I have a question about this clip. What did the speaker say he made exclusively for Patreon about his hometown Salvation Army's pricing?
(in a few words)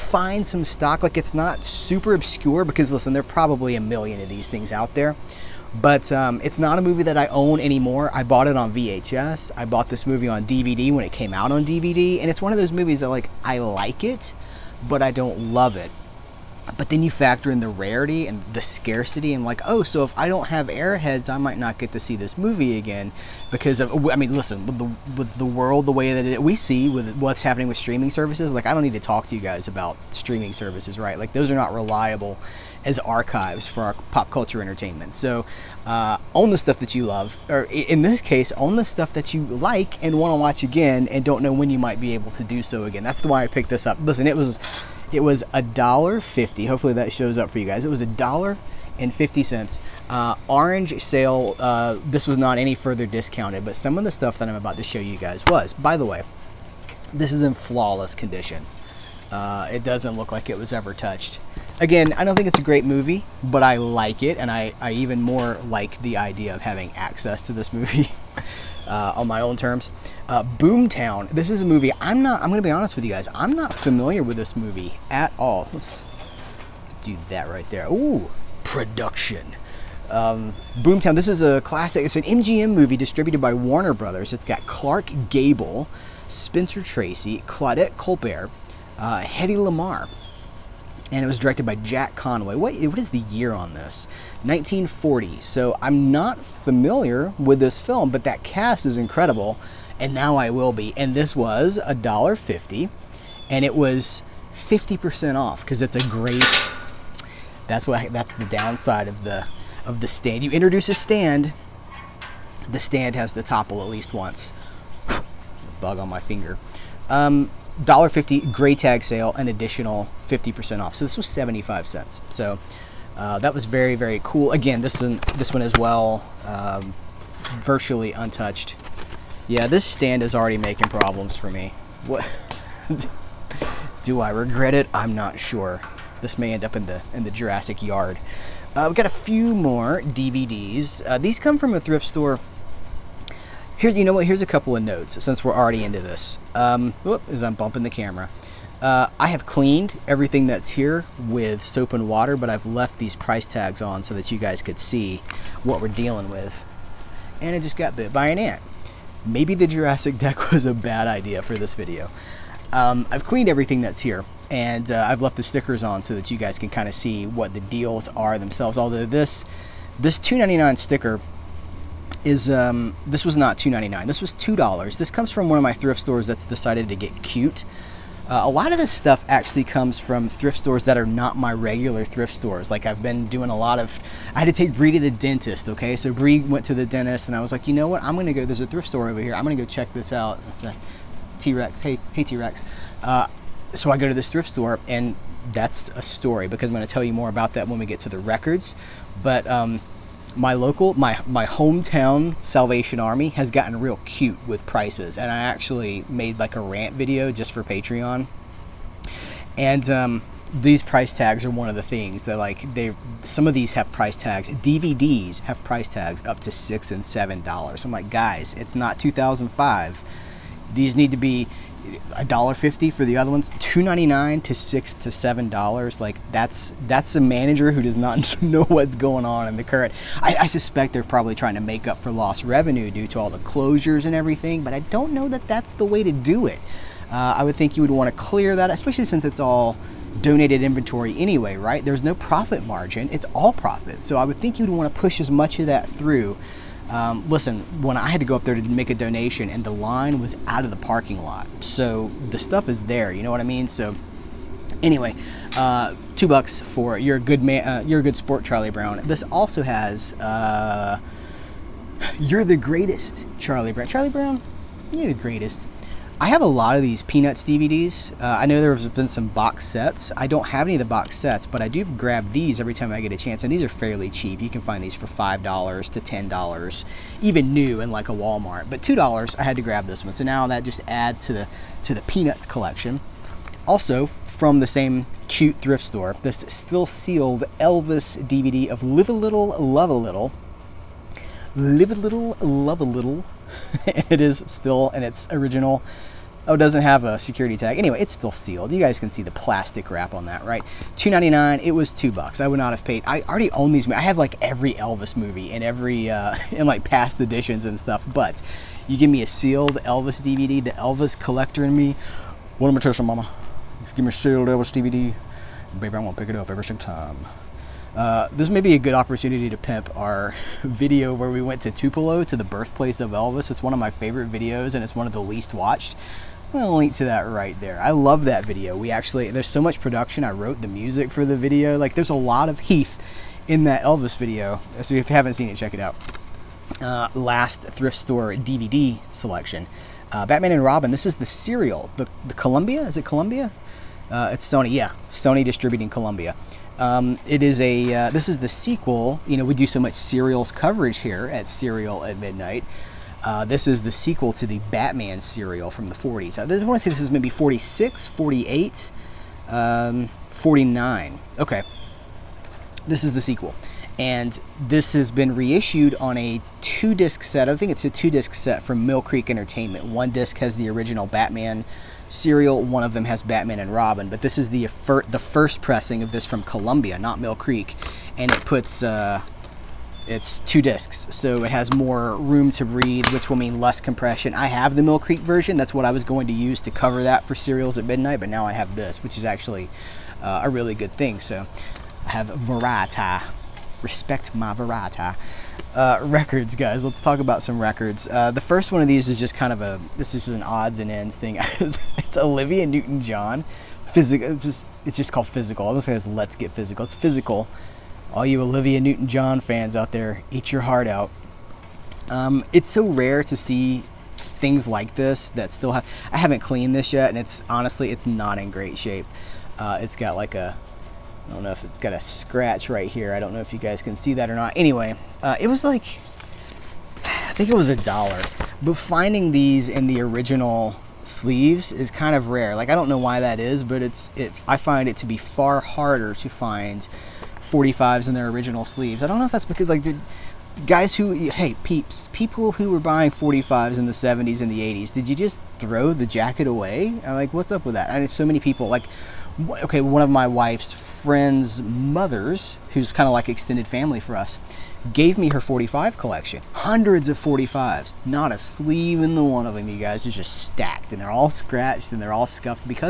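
a rant video.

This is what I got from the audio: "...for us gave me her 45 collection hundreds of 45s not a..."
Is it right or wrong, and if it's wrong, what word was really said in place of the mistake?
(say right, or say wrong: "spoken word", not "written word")
right.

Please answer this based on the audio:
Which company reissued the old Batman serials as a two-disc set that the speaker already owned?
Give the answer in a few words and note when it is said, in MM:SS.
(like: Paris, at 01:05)
Mill Creek Entertainment, at 06:08.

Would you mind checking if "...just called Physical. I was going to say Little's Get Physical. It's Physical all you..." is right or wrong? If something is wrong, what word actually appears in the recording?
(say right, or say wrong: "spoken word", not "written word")
wrong: "Let", not "Little".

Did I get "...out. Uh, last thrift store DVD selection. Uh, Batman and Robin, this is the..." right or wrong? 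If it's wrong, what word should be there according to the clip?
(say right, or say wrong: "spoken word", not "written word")
right.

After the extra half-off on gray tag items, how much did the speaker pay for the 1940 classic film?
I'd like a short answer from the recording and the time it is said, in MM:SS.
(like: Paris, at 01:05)
75 cents, at 02:01.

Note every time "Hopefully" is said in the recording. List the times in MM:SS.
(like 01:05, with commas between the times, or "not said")
00:46.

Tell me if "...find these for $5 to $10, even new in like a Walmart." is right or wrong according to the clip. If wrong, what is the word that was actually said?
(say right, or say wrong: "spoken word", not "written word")
right.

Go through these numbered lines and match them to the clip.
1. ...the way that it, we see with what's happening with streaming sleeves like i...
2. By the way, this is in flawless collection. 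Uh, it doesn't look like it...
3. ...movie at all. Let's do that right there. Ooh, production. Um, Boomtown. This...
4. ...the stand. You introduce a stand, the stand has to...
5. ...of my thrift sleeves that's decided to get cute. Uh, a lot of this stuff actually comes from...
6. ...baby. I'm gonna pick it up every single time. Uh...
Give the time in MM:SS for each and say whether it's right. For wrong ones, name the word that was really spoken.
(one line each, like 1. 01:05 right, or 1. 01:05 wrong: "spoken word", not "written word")
1. 00:25 wrong: "services", not "sleeves"
2. 00:55 wrong: "condition", not "collection"
3. 01:14 right
4. 01:50 right
5. 02:55 wrong: "stores", not "sleeves"
6. 05:15 right.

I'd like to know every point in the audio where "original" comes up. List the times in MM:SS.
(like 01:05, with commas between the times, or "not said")
04:55, 06:10, 07:10, 07:18.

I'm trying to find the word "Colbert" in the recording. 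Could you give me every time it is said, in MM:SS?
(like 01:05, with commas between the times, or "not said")
01:27.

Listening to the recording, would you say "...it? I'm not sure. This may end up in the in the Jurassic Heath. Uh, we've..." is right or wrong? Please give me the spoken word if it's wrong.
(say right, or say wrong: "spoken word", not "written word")
wrong: "Yard", not "Heath".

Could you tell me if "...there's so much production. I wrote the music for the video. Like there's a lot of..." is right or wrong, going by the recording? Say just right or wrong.
right.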